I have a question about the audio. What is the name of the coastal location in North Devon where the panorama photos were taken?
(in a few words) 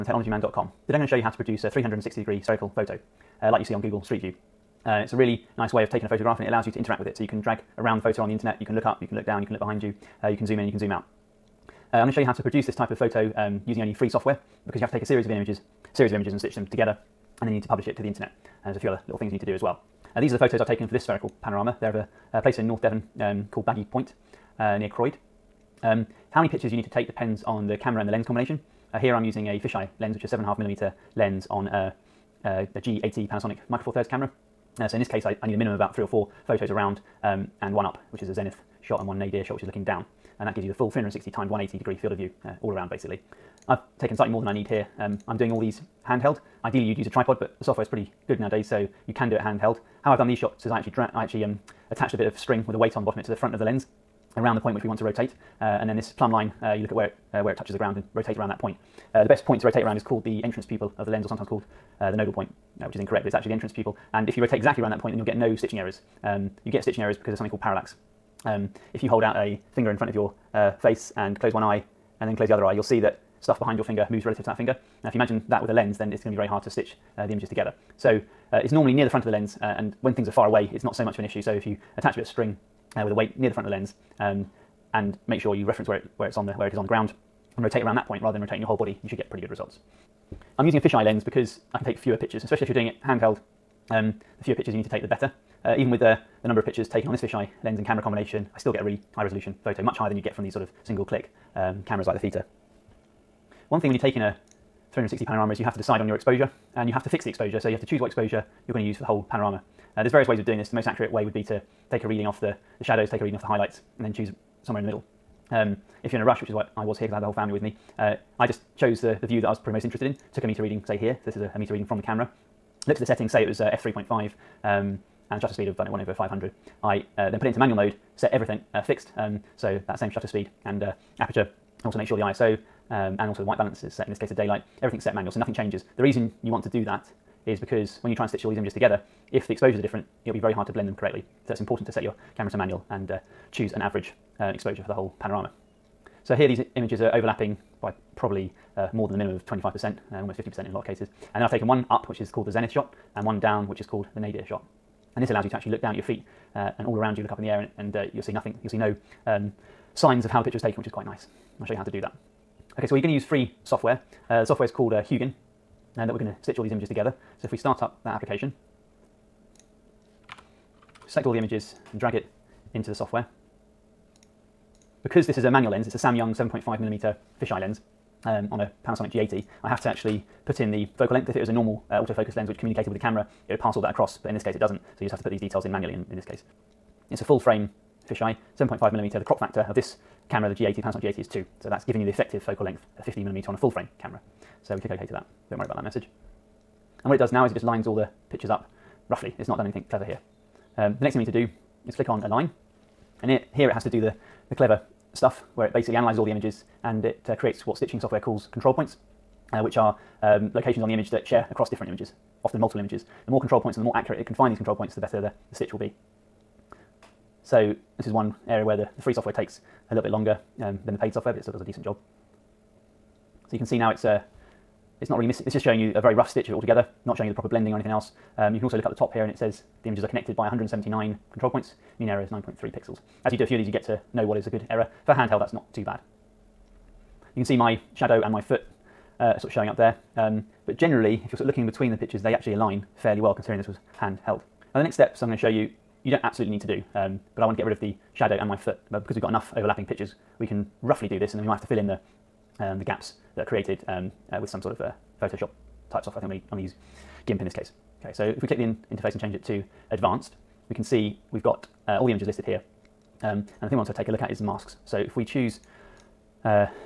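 Baggy Point.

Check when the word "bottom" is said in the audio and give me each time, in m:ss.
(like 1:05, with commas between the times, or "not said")
0:53.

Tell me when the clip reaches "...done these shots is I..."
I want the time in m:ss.
0:50.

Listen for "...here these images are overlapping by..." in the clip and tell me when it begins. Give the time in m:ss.
2:26.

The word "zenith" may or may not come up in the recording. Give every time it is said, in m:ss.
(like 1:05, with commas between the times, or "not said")
0:38, 2:32.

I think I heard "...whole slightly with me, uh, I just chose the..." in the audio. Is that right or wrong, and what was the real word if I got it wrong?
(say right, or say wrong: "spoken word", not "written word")
wrong: "family", not "slightly".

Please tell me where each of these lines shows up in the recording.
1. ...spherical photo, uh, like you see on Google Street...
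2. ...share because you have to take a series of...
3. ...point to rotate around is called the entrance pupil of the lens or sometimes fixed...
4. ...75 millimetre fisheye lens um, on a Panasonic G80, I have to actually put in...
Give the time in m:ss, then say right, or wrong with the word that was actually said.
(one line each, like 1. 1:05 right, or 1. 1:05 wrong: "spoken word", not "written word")
1. 0:02 right
2. 0:14 wrong: "software", not "share"
3. 0:59 wrong: "called", not "fixed"
4. 2:56 right.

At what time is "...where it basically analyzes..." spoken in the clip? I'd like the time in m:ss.
3:25.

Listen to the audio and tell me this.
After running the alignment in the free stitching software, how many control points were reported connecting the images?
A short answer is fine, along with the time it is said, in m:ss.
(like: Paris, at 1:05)
179, at 3:50.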